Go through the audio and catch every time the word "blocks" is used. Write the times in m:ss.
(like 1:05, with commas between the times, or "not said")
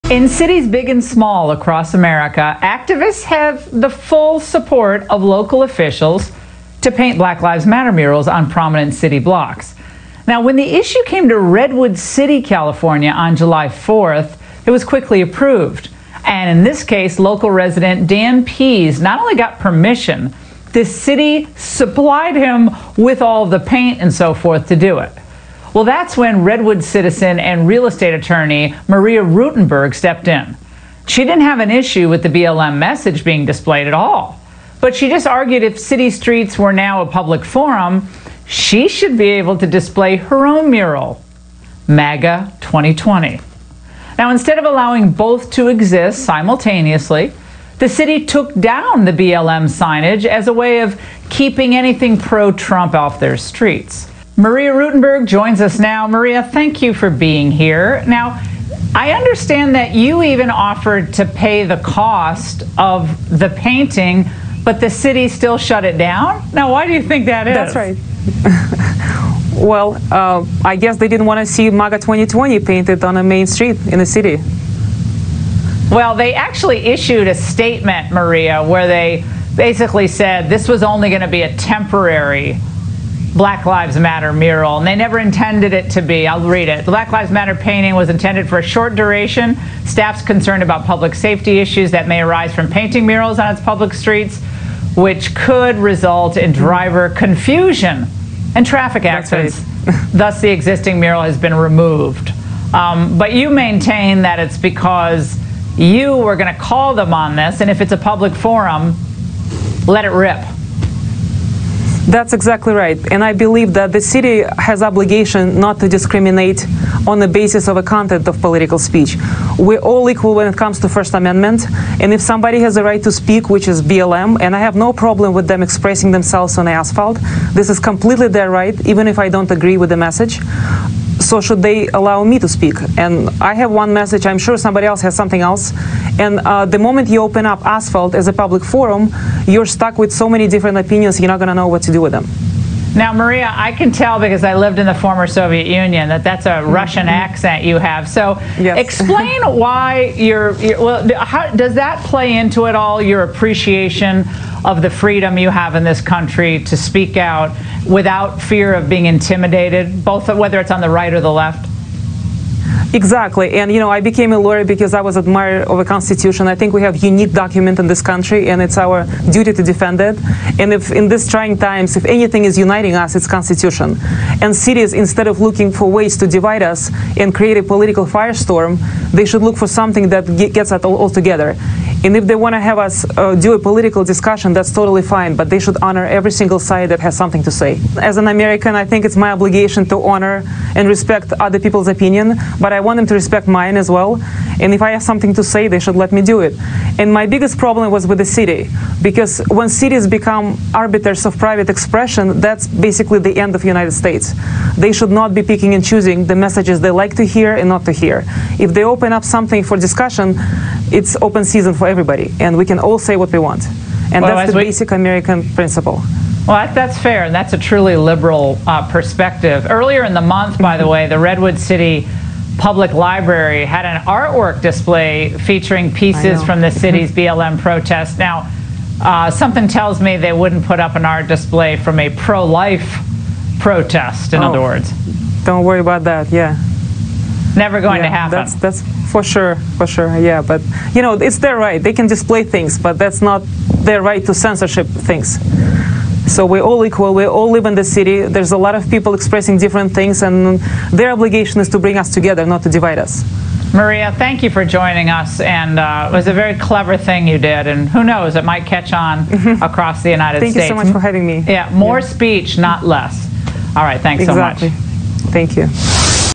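0:09.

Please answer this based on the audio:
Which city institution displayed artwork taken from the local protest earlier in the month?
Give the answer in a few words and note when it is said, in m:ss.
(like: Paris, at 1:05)
Redwood City Public Library, at 3:41.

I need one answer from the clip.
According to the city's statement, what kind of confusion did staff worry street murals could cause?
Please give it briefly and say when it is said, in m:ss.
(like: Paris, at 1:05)
Driver confusion, at 1:36.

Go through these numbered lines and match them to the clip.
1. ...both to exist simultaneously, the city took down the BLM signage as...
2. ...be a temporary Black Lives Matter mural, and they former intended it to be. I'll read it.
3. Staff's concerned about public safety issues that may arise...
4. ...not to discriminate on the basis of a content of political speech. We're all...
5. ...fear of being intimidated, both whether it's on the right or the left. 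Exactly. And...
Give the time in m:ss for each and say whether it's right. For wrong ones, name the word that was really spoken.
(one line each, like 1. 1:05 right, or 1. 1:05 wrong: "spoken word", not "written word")
1. 0:45 right
2. 1:21 wrong: "never", not "former"
3. 1:29 right
4. 1:55 right
5. 2:38 right.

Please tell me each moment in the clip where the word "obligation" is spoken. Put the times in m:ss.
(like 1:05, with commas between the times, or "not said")
1:54, 3:09, 4:11.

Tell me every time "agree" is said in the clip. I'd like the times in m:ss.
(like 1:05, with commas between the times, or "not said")
2:09.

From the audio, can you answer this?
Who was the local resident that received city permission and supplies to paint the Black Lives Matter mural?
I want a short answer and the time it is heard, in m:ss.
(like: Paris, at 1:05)
Dan Pease, at 0:18.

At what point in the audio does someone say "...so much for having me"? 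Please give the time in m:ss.
4:20.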